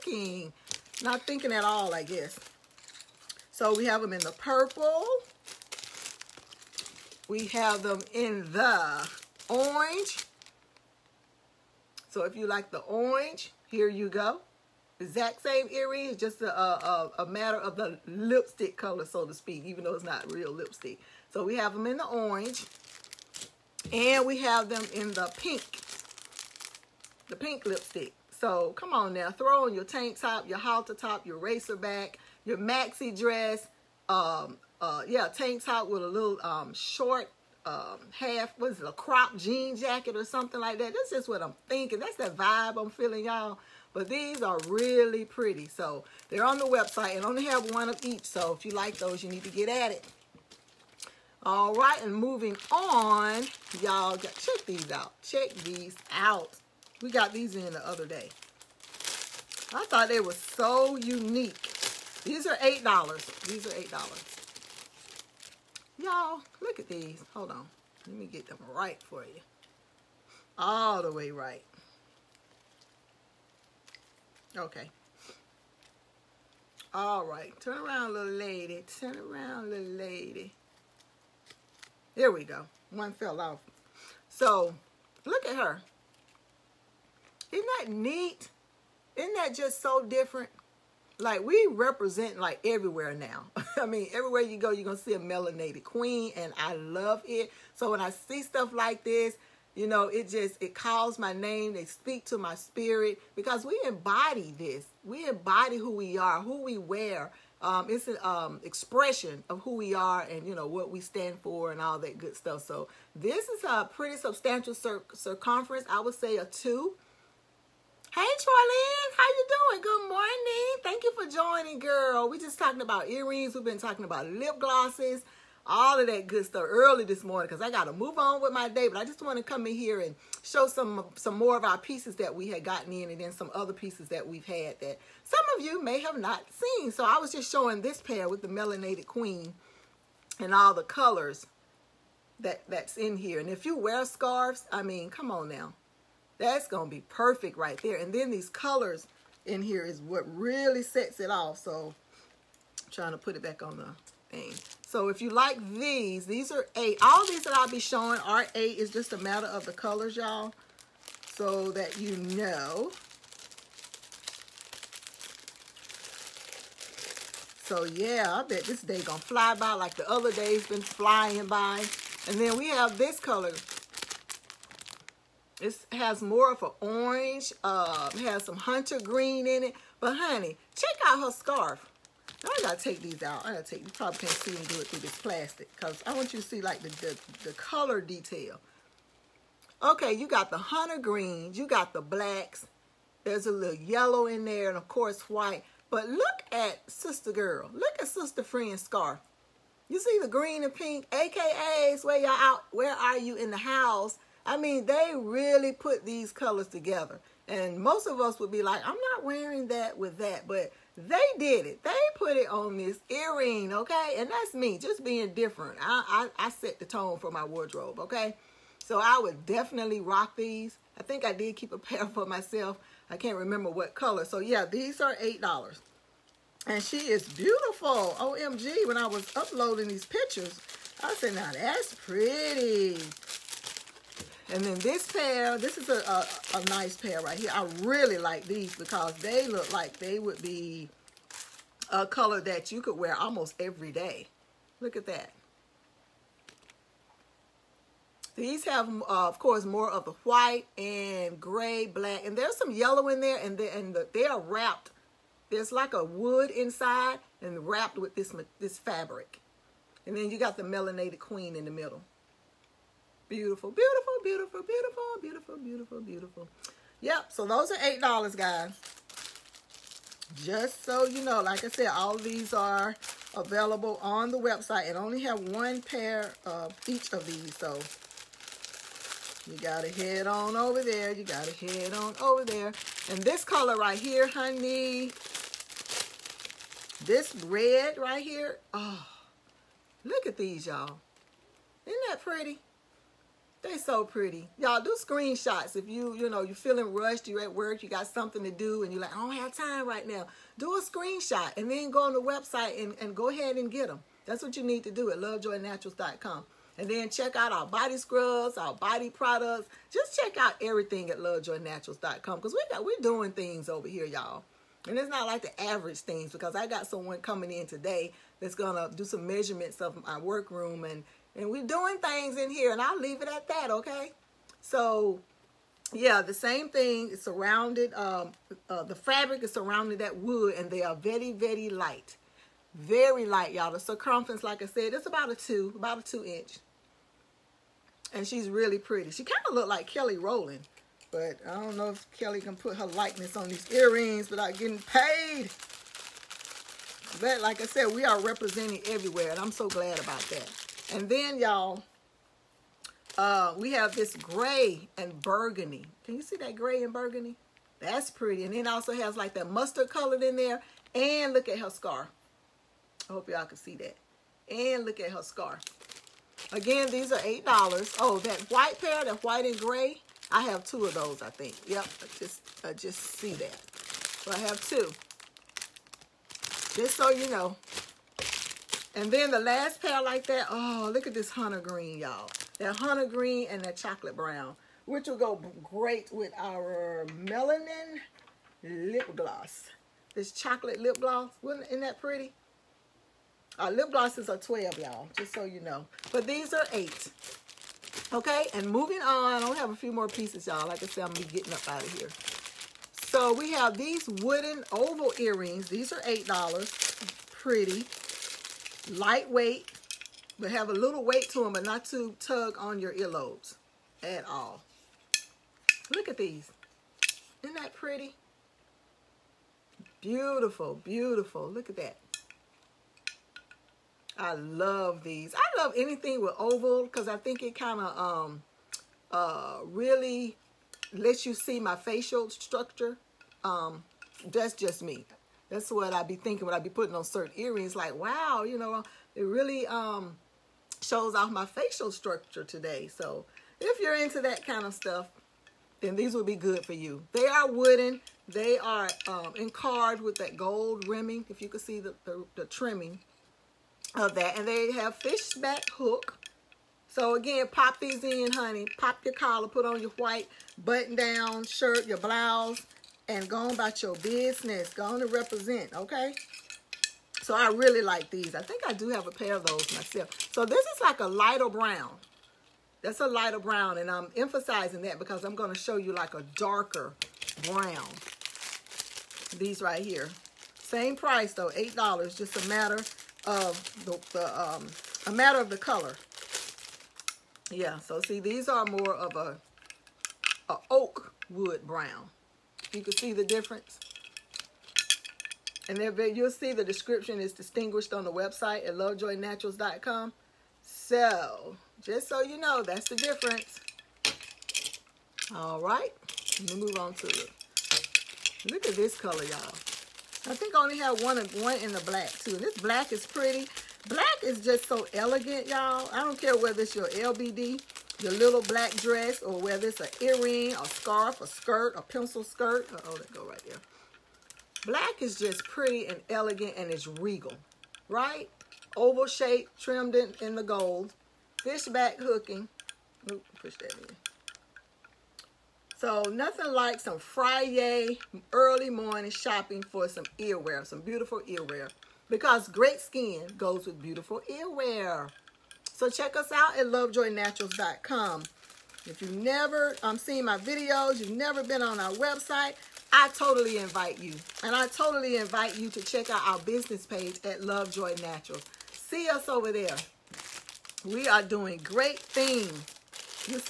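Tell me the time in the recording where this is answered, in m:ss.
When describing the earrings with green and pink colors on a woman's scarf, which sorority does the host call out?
3:21.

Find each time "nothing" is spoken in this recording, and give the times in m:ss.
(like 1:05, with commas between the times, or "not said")
8:56.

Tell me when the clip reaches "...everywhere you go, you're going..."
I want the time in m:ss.
1:34.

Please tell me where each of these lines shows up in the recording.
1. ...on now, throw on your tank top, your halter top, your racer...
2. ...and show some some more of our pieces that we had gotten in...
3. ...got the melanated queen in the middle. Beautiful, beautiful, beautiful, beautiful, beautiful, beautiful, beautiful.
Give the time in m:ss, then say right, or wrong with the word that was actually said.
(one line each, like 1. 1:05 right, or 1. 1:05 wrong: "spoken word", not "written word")
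1. 0:28 right
2. 2:09 right
3. 4:20 right.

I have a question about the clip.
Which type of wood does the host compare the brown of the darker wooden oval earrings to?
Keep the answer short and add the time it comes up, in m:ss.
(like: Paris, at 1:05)
Oak, at 8:10.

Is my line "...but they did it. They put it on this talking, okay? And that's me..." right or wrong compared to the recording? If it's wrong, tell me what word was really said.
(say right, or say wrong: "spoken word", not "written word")
wrong: "earring", not "talking".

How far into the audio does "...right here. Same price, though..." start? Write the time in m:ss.
7:59.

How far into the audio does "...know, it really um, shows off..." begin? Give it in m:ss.
7:18.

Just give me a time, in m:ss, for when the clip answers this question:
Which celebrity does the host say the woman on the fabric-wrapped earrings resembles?
5:39.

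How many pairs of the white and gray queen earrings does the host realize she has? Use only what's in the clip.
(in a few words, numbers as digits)
2.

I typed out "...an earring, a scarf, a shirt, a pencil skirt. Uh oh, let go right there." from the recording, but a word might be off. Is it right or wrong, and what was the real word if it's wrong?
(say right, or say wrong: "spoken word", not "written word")
wrong: "skirt", not "shirt".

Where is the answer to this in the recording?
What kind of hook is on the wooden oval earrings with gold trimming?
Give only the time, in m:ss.
7:34.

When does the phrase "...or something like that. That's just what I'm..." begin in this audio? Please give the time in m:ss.
0:40.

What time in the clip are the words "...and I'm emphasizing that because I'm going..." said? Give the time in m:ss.
7:53.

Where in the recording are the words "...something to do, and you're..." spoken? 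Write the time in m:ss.
4:58.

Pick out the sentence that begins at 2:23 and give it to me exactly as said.
And if you wear scarves, I mean, come on now.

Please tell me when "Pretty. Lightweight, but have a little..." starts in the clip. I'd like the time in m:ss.
6:47.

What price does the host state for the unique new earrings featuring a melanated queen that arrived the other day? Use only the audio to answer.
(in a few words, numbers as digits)
$8.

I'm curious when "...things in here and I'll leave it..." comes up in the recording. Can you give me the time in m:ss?
5:21.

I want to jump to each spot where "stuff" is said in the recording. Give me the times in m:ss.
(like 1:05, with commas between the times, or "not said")
1:38, 1:52, 2:06, 7:24.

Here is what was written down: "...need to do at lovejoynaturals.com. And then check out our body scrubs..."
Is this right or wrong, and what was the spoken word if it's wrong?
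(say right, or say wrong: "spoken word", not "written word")
right.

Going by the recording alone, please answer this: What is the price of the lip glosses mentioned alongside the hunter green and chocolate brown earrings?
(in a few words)
$12.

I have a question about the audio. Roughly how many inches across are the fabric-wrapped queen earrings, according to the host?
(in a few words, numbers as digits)
2 inches.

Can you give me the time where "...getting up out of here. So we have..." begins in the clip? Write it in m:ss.
6:41.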